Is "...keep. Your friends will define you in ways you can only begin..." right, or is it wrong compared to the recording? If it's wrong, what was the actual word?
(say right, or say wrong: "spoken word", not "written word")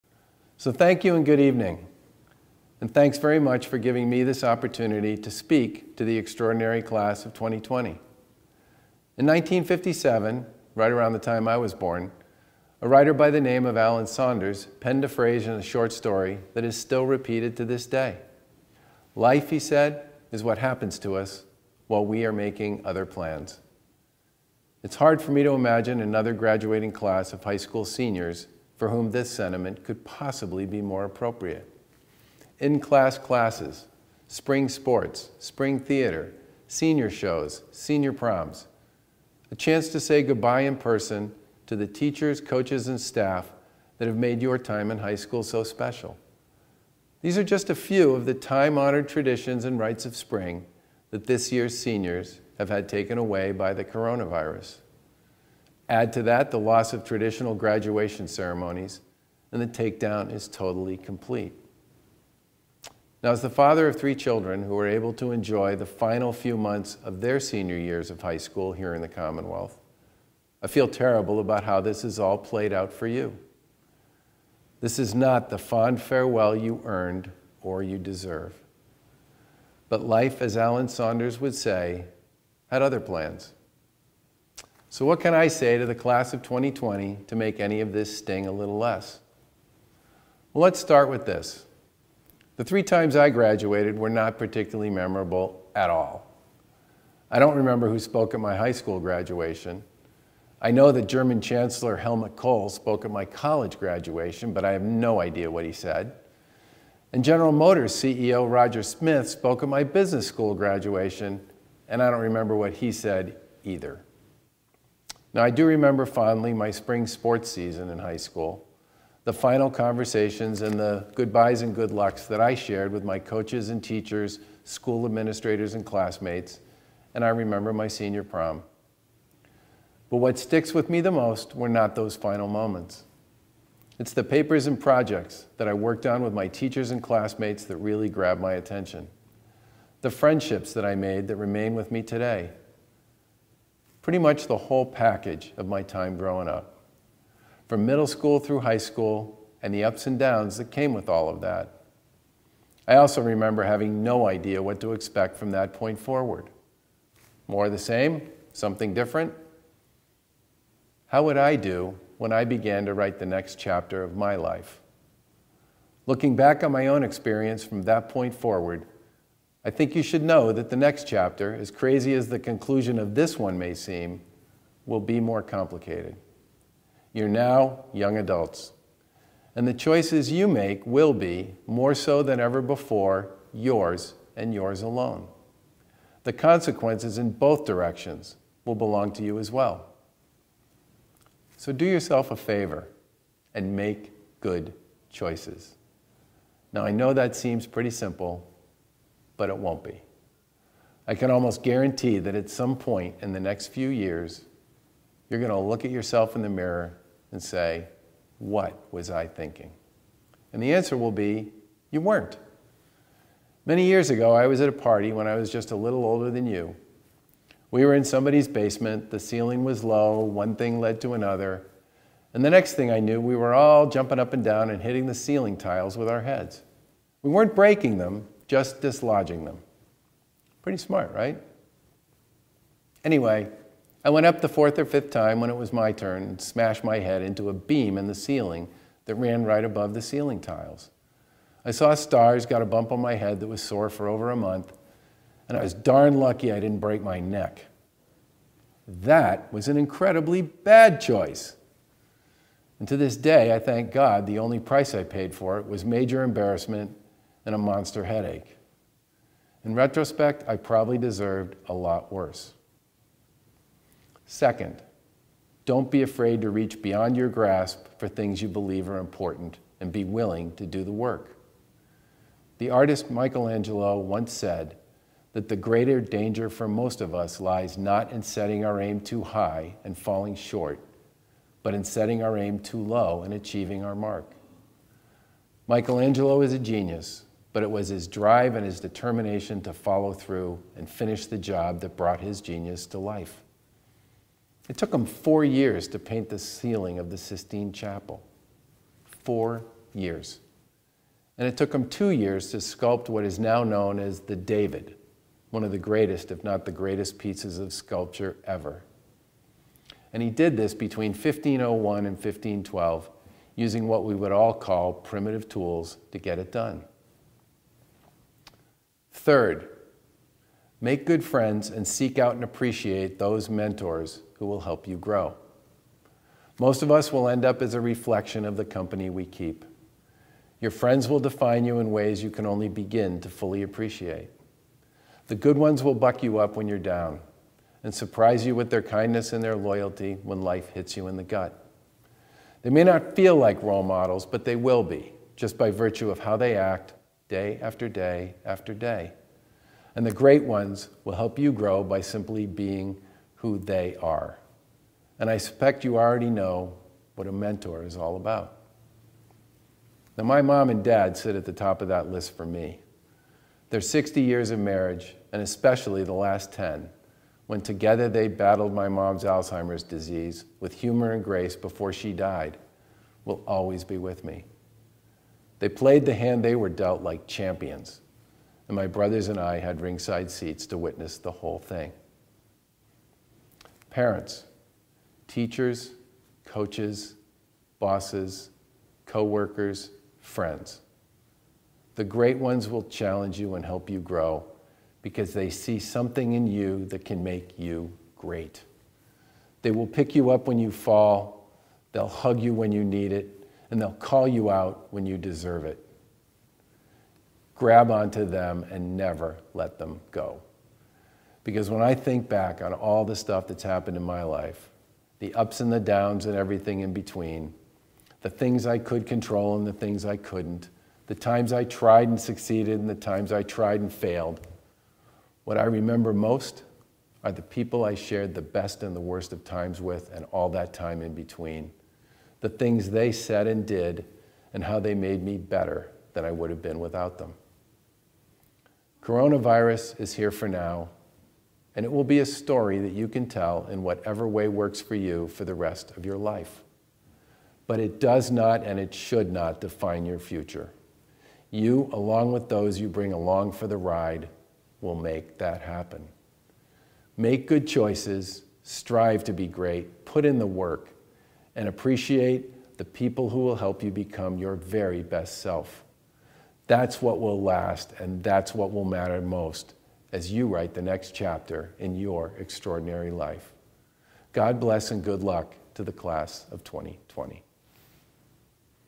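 right.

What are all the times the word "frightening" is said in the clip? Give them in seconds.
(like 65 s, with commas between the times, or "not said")
not said.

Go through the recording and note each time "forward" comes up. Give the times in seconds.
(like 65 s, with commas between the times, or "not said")
155 s, 168 s.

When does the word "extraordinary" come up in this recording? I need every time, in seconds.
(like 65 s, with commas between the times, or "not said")
6 s, 472 s.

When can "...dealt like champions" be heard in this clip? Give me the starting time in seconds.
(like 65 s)
376 s.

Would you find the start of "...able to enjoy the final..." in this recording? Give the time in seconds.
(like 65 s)
64 s.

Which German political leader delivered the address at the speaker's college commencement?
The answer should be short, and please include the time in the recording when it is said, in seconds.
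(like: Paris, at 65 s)
Helmut Kohl, at 101 s.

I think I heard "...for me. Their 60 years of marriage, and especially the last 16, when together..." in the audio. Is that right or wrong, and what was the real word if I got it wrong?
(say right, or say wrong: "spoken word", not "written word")
wrong: "10", not "16".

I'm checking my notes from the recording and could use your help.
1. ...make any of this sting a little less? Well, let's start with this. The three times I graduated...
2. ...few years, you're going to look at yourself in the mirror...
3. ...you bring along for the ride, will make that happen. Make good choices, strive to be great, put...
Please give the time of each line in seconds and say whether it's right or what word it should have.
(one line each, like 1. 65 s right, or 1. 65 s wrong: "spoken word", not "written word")
1. 87 s right
2. 203 s right
3. 452 s right.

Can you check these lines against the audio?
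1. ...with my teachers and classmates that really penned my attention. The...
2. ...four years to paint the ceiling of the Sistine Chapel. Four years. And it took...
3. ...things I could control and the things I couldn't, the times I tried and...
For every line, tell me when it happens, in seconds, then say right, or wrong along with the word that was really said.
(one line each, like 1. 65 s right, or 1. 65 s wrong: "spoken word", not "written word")
1. 136 s wrong: "grabbed", not "penned"
2. 295 s right
3. 418 s right.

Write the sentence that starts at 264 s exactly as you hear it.
Second, don't be afraid to reach beyond your grasp for things you believe are important and be willing to do the work.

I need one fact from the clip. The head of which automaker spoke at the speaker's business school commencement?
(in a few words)
General Motors.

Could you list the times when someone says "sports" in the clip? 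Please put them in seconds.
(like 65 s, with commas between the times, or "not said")
34 s, 117 s.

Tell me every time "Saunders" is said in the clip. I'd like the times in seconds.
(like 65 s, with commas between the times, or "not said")
14 s, 80 s.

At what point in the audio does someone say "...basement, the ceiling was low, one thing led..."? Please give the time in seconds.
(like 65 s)
218 s.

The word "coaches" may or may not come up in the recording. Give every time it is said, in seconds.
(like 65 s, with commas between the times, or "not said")
42 s, 123 s, 386 s.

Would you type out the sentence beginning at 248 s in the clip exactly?
That was an incredibly bad choice.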